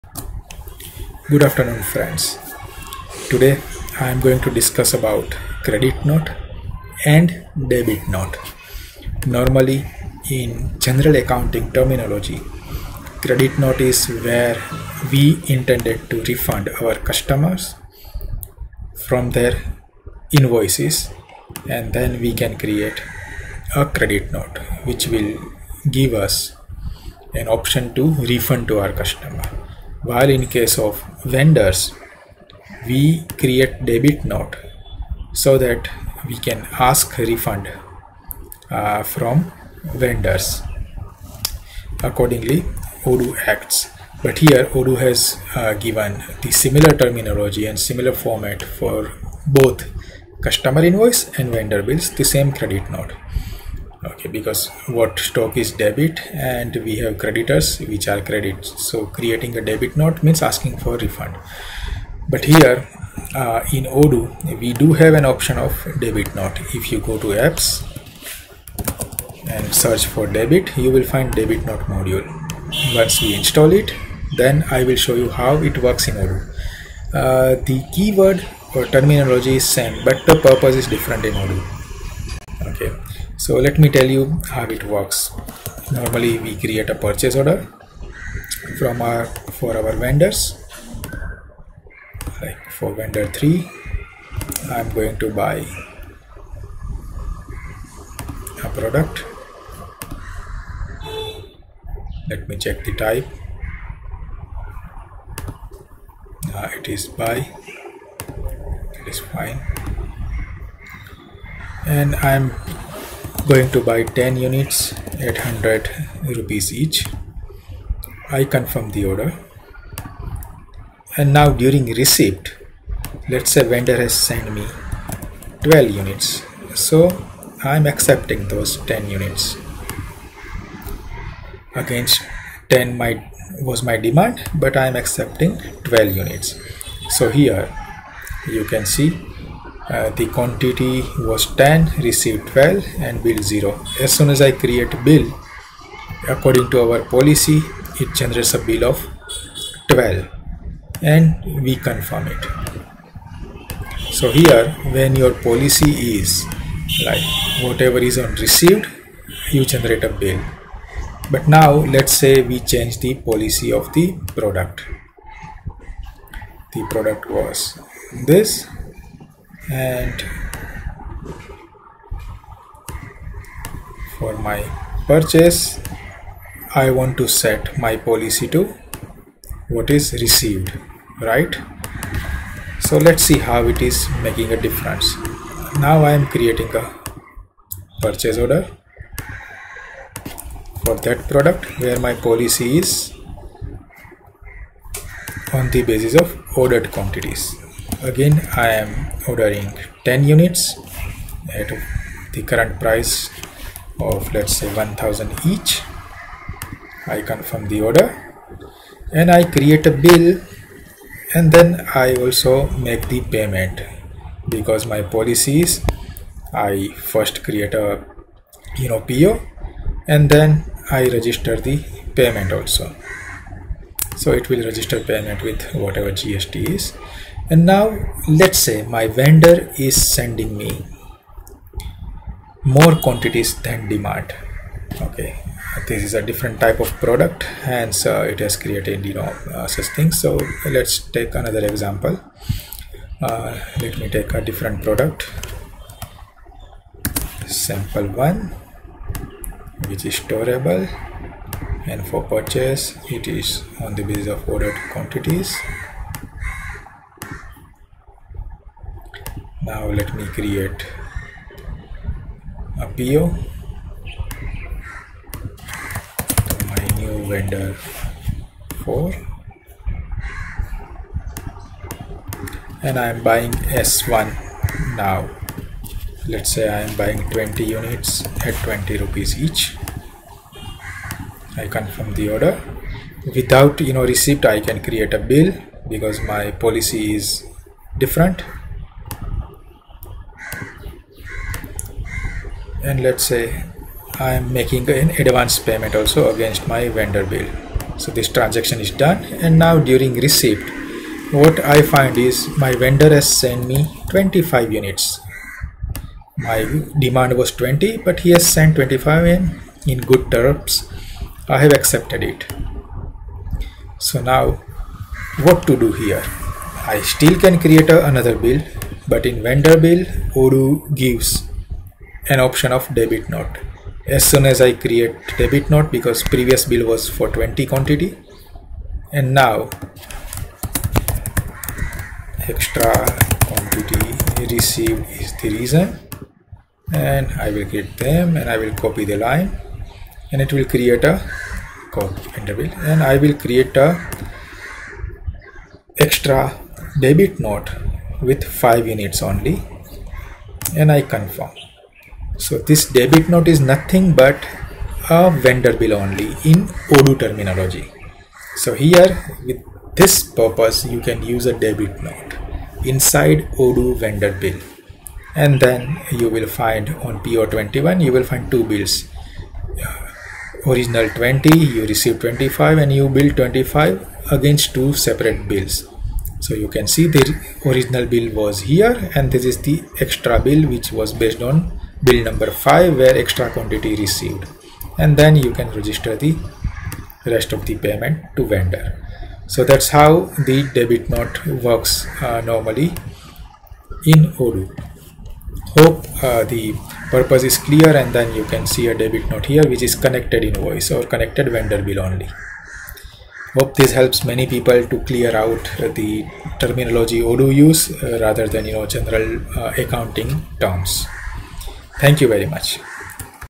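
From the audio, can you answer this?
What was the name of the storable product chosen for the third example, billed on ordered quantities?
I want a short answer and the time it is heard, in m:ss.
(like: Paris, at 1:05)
sample one, at 4:07.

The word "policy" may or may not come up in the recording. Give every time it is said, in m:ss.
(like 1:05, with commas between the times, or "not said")
2:27, 2:35, 2:43, 2:57, 3:12, 3:35, 4:46.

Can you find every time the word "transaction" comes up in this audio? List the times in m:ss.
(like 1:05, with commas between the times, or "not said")
4:58.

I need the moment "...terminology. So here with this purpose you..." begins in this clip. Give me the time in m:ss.
5:57.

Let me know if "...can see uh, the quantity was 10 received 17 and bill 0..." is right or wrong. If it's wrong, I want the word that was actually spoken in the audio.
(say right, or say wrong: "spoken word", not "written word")
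wrong: "12", not "17".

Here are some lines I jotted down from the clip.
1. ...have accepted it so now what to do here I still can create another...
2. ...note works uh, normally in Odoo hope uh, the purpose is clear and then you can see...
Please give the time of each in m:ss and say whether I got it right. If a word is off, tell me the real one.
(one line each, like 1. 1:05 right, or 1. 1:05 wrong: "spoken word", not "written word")
1. 5:11 right
2. 6:31 right.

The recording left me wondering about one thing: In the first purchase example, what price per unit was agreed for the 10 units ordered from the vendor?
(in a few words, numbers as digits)
800 rupees.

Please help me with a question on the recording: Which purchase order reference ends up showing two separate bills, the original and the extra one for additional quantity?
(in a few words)
PO21.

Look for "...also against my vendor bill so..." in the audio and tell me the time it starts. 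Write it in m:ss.
4:55.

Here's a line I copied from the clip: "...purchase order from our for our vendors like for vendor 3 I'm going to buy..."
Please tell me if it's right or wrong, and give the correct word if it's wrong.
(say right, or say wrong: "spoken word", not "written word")
right.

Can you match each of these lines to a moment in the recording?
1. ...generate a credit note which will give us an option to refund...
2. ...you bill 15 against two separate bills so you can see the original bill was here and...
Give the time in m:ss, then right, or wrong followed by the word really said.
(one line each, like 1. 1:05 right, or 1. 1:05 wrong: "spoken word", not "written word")
1. 0:22 wrong: "create", not "generate"
2. 6:12 wrong: "25", not "15".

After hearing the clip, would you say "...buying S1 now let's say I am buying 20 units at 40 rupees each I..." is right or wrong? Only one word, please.
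wrong.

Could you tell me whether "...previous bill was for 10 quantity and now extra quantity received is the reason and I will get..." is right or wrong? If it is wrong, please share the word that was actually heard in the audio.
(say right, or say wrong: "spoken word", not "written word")
wrong: "20", not "10".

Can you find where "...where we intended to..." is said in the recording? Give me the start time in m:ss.
0:14.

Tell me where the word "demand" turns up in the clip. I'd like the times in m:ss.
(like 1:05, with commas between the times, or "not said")
2:13, 3:53, 5:06.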